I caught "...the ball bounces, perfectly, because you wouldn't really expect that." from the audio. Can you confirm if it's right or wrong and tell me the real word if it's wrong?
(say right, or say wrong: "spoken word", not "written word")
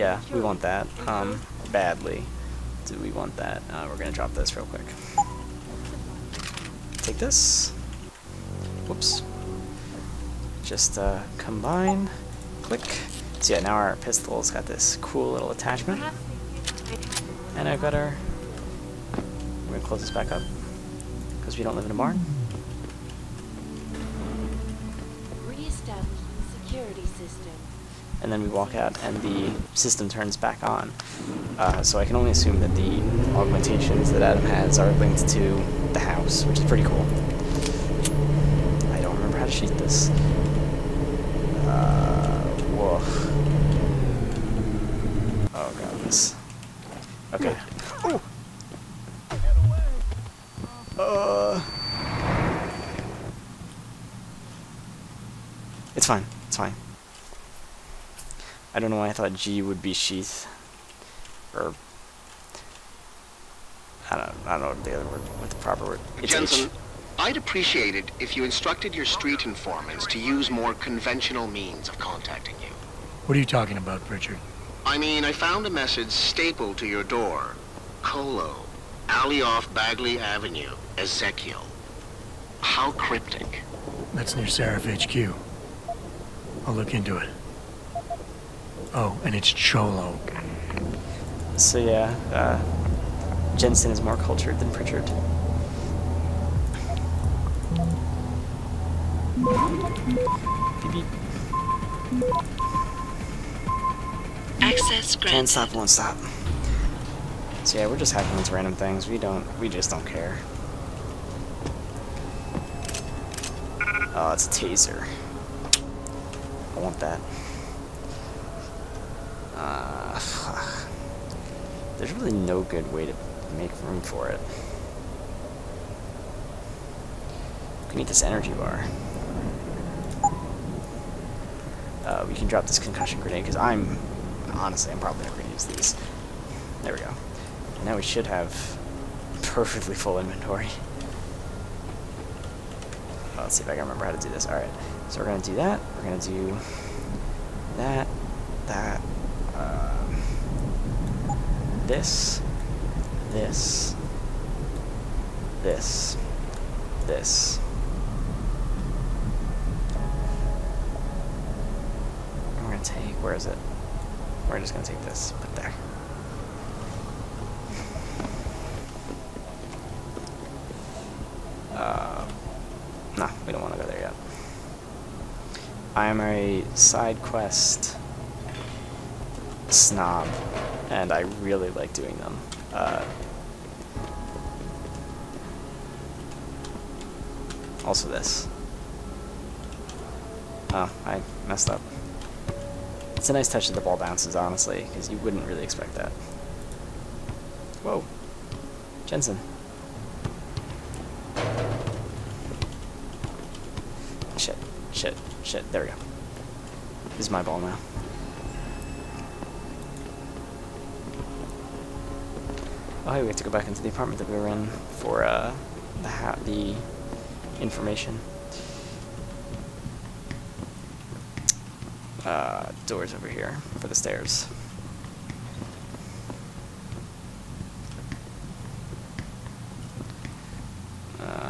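wrong: "honestly", not "perfectly".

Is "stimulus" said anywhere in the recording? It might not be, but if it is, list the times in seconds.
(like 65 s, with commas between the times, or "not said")
not said.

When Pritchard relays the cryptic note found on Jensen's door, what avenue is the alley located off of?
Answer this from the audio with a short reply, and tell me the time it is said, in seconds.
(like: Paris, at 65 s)
Bagley Avenue, at 79 s.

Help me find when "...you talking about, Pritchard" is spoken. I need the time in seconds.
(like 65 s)
73 s.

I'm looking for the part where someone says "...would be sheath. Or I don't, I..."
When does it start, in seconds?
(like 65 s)
59 s.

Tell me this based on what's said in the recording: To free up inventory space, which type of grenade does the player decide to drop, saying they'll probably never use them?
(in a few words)
Concussion grenade.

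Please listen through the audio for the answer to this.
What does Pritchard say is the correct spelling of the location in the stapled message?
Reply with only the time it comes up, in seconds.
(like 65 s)
89 s.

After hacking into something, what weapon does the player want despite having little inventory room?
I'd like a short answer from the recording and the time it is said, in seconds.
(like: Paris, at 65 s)
Taser, at 114 s.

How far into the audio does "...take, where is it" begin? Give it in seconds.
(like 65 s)
162 s.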